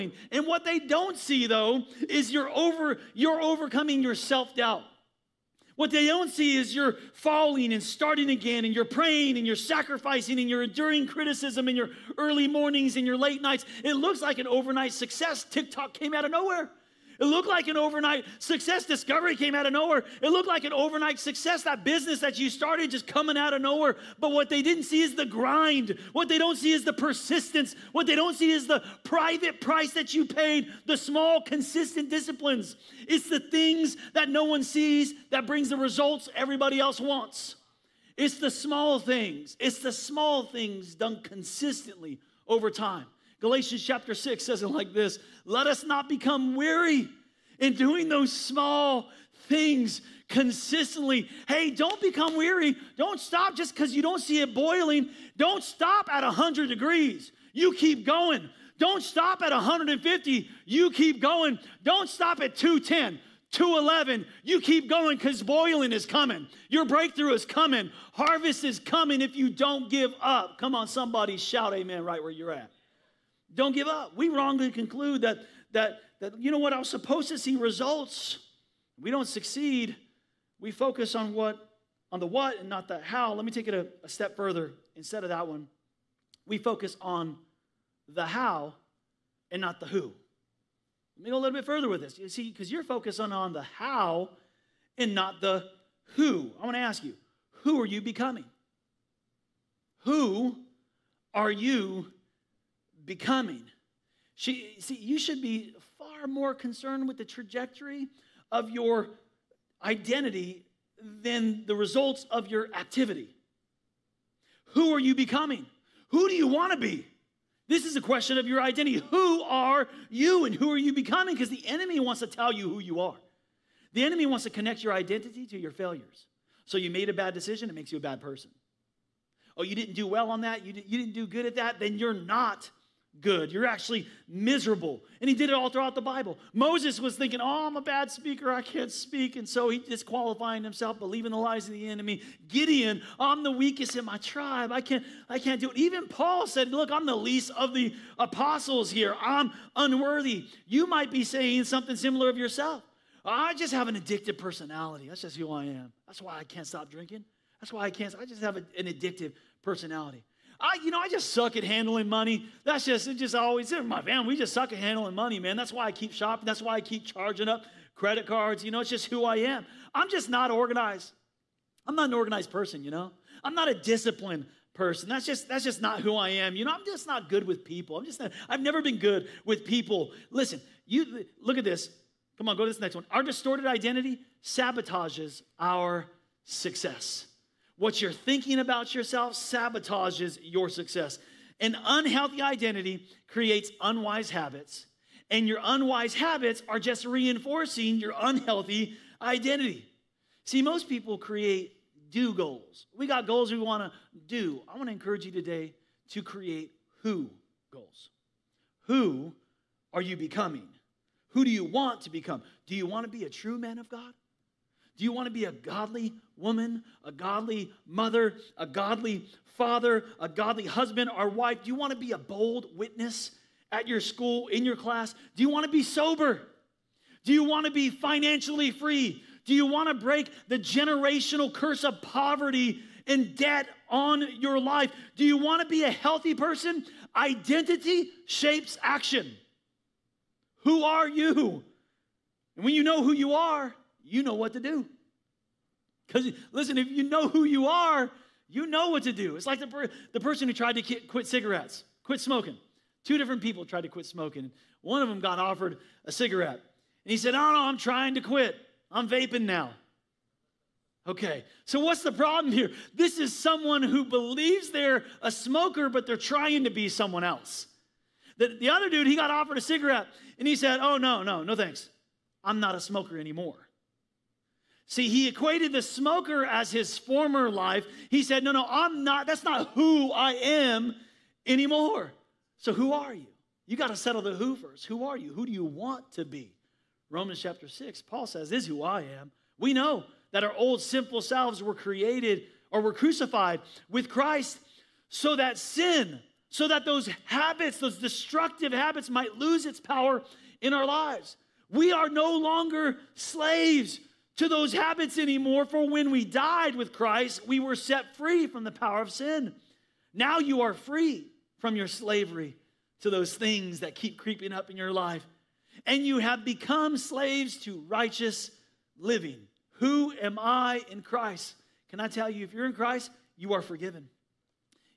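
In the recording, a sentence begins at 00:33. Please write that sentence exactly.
It's the things that no one sees that brings the results everybody else wants.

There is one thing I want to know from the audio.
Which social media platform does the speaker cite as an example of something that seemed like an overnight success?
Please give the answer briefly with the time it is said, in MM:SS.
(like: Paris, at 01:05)
TikTok, at 00:15.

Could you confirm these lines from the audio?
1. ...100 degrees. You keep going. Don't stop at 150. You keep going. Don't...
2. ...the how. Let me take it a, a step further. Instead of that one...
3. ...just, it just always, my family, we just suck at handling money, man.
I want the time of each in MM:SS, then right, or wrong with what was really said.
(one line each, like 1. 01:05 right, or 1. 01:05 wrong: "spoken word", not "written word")
1. 00:56 right
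2. 01:22 right
3. 02:42 right.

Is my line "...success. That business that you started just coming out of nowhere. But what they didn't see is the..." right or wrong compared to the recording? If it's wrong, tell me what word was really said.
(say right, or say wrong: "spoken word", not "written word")
right.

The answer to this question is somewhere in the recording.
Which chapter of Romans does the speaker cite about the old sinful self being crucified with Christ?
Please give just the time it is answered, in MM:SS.
04:47.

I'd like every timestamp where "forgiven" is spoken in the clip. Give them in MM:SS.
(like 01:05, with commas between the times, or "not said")
05:23.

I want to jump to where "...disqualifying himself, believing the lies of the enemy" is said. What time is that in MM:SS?
02:19.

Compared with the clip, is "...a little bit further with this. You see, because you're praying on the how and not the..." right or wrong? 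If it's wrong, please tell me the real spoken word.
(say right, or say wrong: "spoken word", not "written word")
wrong: "focusing", not "praying".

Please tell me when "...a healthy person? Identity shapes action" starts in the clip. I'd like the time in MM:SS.
03:55.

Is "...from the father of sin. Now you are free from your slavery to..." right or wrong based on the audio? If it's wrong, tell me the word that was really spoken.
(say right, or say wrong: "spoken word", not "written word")
wrong: "power", not "father".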